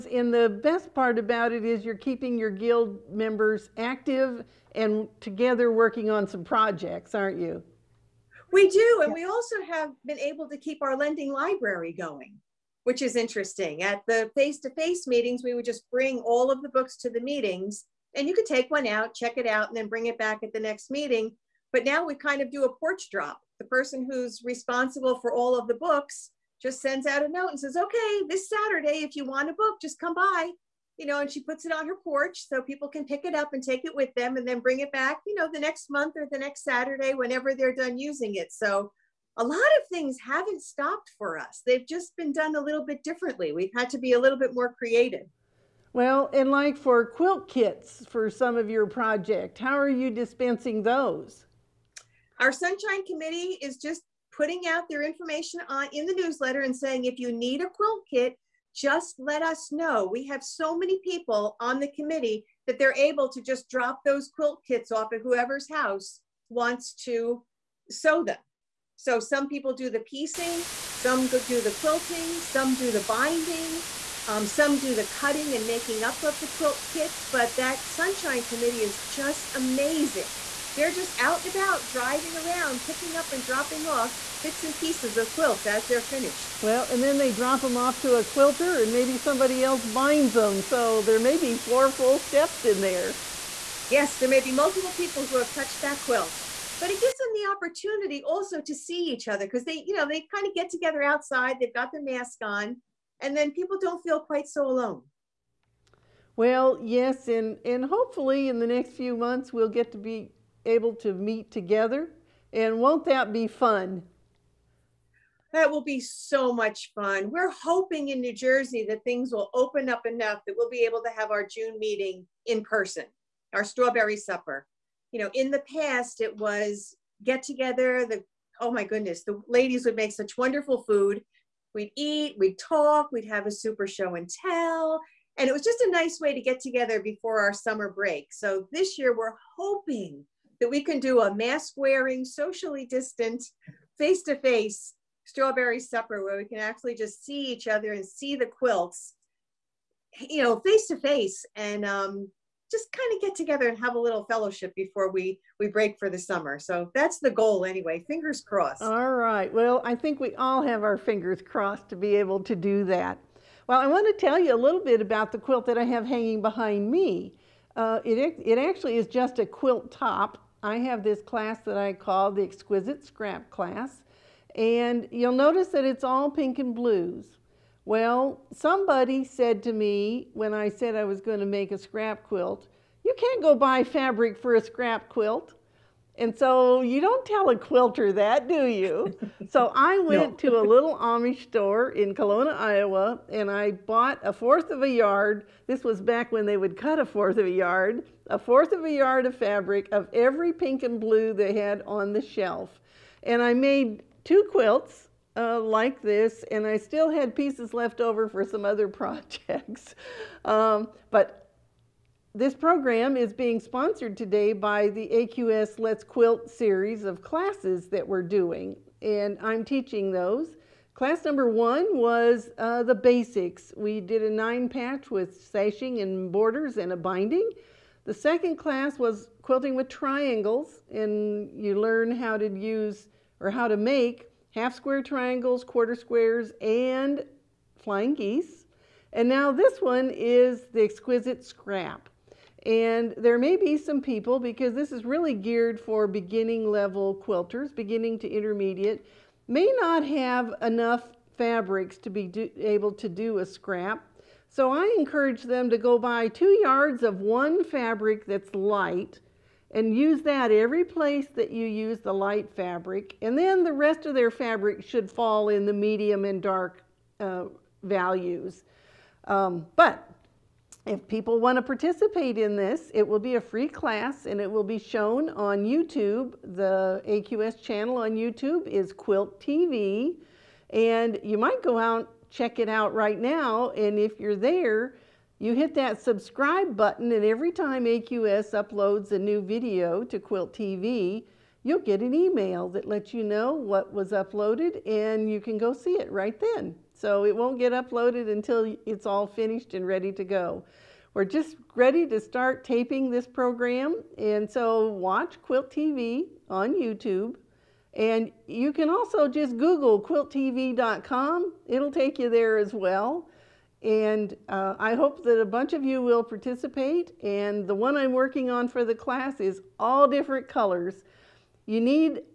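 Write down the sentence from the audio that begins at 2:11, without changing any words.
We'd eat, we'd talk, we'd have a super show and tell.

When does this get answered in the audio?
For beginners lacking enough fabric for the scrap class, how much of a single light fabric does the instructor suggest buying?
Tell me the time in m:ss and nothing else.
4:16.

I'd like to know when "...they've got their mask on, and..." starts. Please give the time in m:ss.
1:41.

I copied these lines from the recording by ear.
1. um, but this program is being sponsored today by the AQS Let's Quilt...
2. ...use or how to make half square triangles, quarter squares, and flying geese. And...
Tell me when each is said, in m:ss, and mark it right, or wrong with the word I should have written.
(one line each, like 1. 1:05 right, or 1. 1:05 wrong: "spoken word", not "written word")
1. 3:30 right
2. 3:52 right.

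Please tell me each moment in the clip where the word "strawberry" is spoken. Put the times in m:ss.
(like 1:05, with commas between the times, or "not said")
2:03, 2:25.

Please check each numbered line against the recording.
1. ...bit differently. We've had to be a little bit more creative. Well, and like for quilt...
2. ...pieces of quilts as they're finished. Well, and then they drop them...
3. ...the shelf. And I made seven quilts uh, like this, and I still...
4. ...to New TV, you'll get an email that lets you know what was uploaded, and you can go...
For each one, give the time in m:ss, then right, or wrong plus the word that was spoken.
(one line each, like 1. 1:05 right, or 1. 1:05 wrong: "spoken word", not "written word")
1. 0:42 right
2. 1:24 right
3. 3:22 wrong: "two", not "seven"
4. 4:50 wrong: "Quilt", not "New".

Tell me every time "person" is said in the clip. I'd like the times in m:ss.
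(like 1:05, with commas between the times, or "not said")
0:23, 2:02.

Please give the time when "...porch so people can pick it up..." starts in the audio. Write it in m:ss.
0:32.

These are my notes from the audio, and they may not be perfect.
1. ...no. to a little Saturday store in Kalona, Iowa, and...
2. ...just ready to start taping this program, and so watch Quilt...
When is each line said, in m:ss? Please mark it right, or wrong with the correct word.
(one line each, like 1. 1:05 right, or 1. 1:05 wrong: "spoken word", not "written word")
1. 3:10 wrong: "Amish", not "Saturday"
2. 5:01 right.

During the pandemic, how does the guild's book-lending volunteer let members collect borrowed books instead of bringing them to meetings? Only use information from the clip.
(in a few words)
porch drop.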